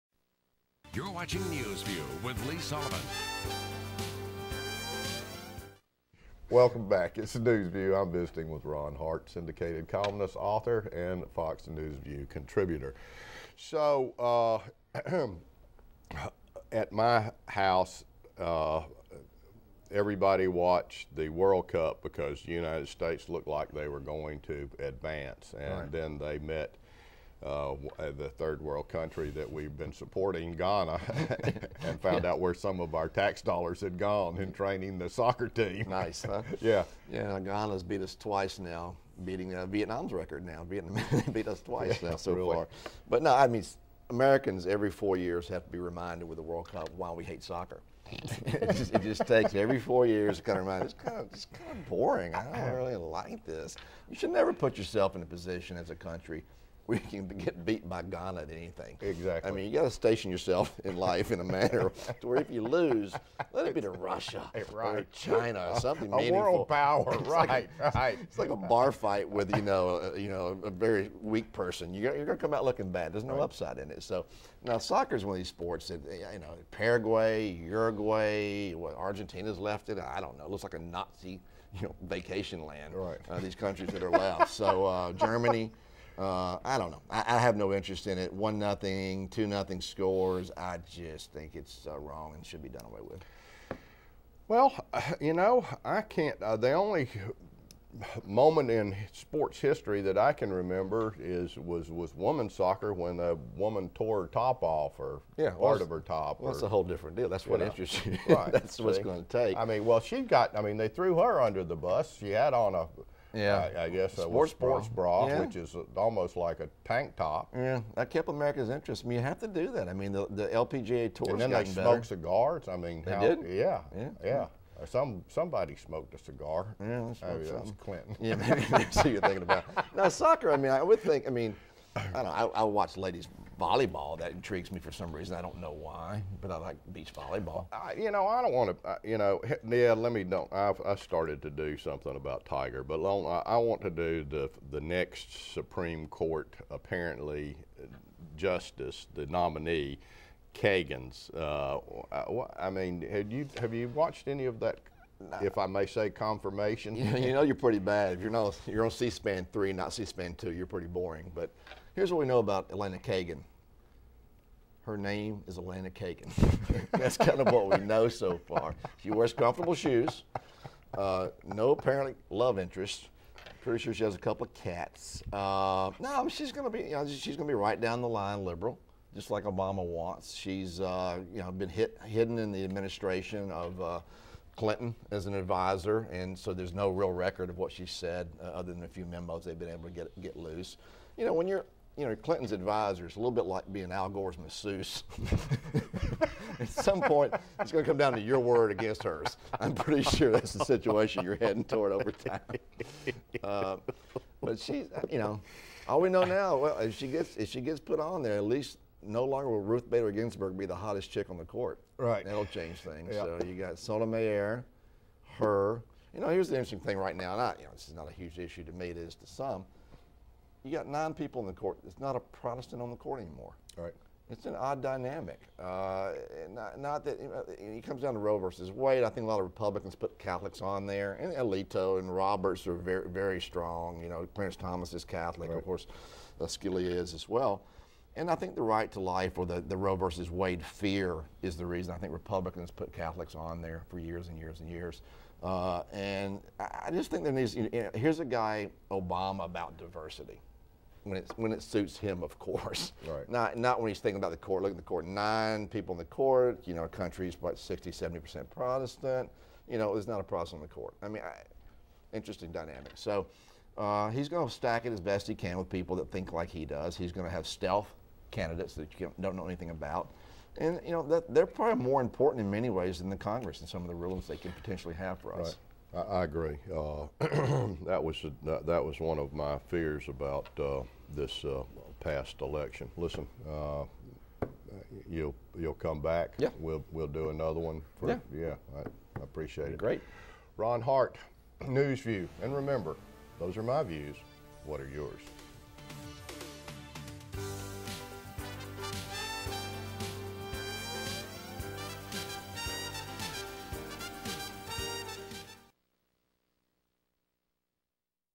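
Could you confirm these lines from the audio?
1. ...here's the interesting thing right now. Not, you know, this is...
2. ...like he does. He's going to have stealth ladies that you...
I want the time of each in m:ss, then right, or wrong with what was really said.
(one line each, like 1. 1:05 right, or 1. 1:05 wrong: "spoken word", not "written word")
1. 3:36 right
2. 4:26 wrong: "candidates", not "ladies".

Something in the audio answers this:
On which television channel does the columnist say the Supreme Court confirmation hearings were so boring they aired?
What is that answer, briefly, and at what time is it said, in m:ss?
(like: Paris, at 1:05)
C-SPAN 3, at 2:38.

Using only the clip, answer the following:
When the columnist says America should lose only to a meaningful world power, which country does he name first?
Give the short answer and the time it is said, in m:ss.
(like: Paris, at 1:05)
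Russia, at 1:03.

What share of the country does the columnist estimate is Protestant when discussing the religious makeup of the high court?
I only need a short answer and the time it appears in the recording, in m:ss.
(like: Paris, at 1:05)
60-70%, at 4:17.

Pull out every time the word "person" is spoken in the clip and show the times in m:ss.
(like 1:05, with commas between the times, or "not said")
1:11.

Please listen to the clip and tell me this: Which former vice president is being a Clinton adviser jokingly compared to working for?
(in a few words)
Al Gore.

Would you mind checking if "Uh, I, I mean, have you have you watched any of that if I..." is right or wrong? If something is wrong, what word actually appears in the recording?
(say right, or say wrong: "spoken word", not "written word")
right.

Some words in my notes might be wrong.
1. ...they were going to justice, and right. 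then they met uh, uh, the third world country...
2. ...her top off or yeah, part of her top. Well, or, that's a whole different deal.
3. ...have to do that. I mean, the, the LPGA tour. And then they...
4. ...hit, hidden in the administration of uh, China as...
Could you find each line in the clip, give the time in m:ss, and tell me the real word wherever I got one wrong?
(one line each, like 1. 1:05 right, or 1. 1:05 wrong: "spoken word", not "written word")
1. 0:23 wrong: "advance", not "justice"
2. 1:44 right
3. 1:59 right
4. 3:01 wrong: "Clinton", not "China".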